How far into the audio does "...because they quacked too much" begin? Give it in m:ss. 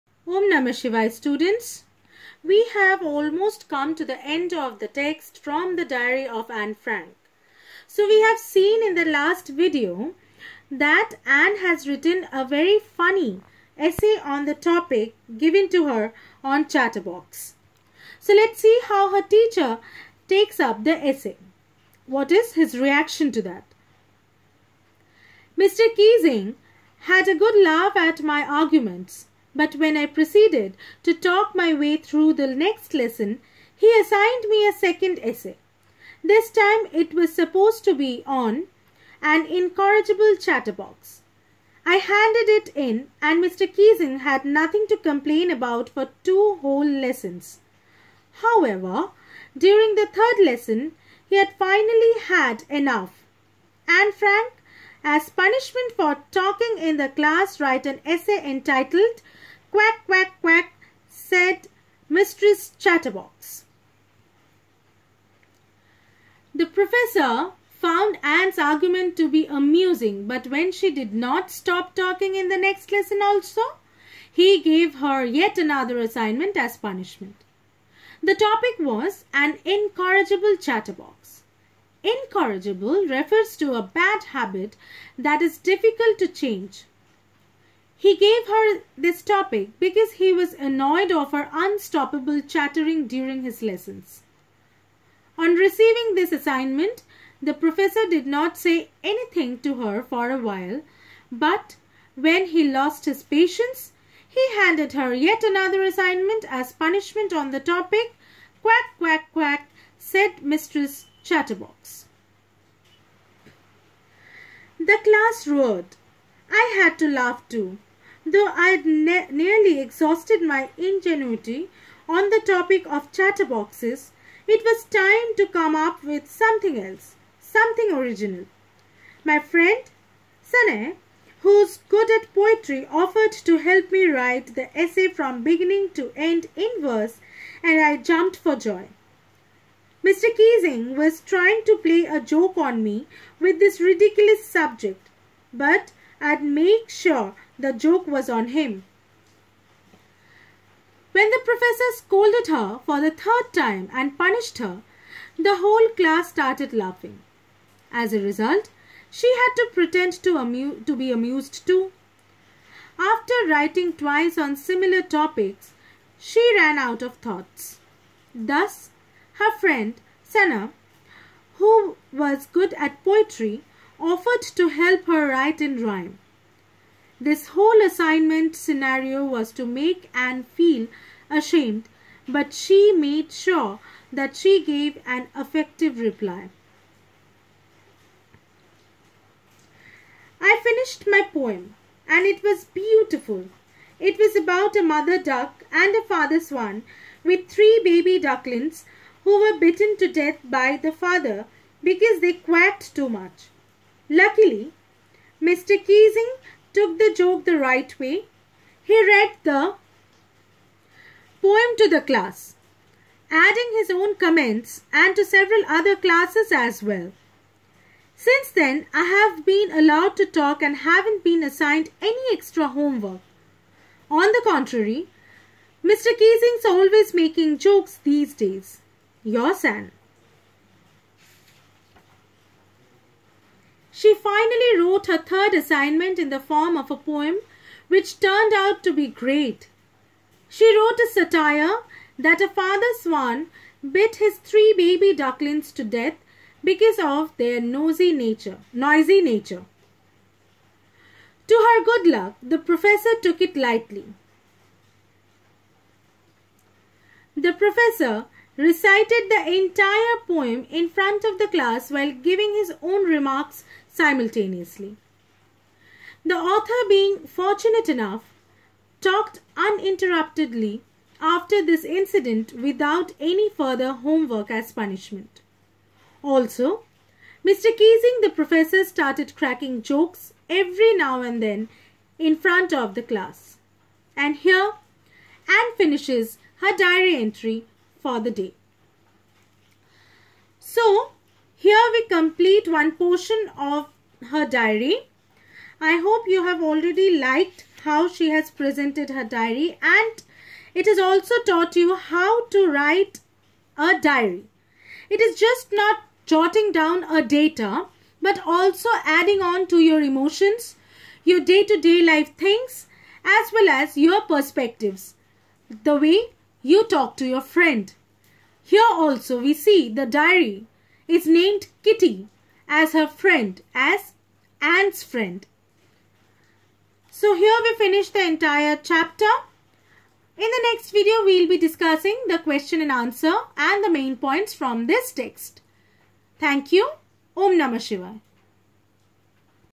3:21.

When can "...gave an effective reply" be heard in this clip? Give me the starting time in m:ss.
3:04.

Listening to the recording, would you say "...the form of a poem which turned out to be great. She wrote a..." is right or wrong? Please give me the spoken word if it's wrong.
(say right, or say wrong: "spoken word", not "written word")
right.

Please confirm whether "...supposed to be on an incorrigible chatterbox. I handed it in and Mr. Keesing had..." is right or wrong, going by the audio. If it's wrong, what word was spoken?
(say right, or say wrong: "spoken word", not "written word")
right.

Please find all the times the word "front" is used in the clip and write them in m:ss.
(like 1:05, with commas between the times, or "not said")
4:20, 4:42.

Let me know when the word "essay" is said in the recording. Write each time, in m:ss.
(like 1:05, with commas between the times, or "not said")
0:13, 0:21, 0:35, 0:58, 2:14.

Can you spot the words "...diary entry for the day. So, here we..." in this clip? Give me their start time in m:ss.
4:46.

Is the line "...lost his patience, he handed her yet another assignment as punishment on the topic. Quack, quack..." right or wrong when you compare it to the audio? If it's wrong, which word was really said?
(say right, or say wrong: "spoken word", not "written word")
right.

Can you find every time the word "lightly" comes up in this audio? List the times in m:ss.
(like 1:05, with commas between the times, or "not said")
4:13.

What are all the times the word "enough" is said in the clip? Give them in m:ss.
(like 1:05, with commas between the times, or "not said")
0:52, 4:27.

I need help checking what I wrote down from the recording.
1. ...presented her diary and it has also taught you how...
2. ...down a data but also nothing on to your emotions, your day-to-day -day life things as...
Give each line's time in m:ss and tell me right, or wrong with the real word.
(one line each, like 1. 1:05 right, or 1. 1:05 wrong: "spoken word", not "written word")
1. 4:58 right
2. 5:06 wrong: "adding", not "nothing".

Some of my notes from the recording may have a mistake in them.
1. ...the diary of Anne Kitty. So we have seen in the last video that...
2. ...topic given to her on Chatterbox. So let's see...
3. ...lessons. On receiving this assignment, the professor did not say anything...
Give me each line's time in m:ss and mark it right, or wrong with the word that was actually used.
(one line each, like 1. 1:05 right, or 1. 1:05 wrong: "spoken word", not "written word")
1. 0:05 wrong: "Frank", not "Kitty"
2. 0:14 right
3. 1:33 right.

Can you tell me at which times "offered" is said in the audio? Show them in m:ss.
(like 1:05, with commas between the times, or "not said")
2:12, 2:53.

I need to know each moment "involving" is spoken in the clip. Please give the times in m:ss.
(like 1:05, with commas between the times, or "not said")
not said.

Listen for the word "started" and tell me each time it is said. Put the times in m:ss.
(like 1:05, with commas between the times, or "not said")
2:36, 4:38.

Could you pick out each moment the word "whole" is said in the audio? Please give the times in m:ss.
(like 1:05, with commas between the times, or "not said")
0:46, 2:35, 2:57.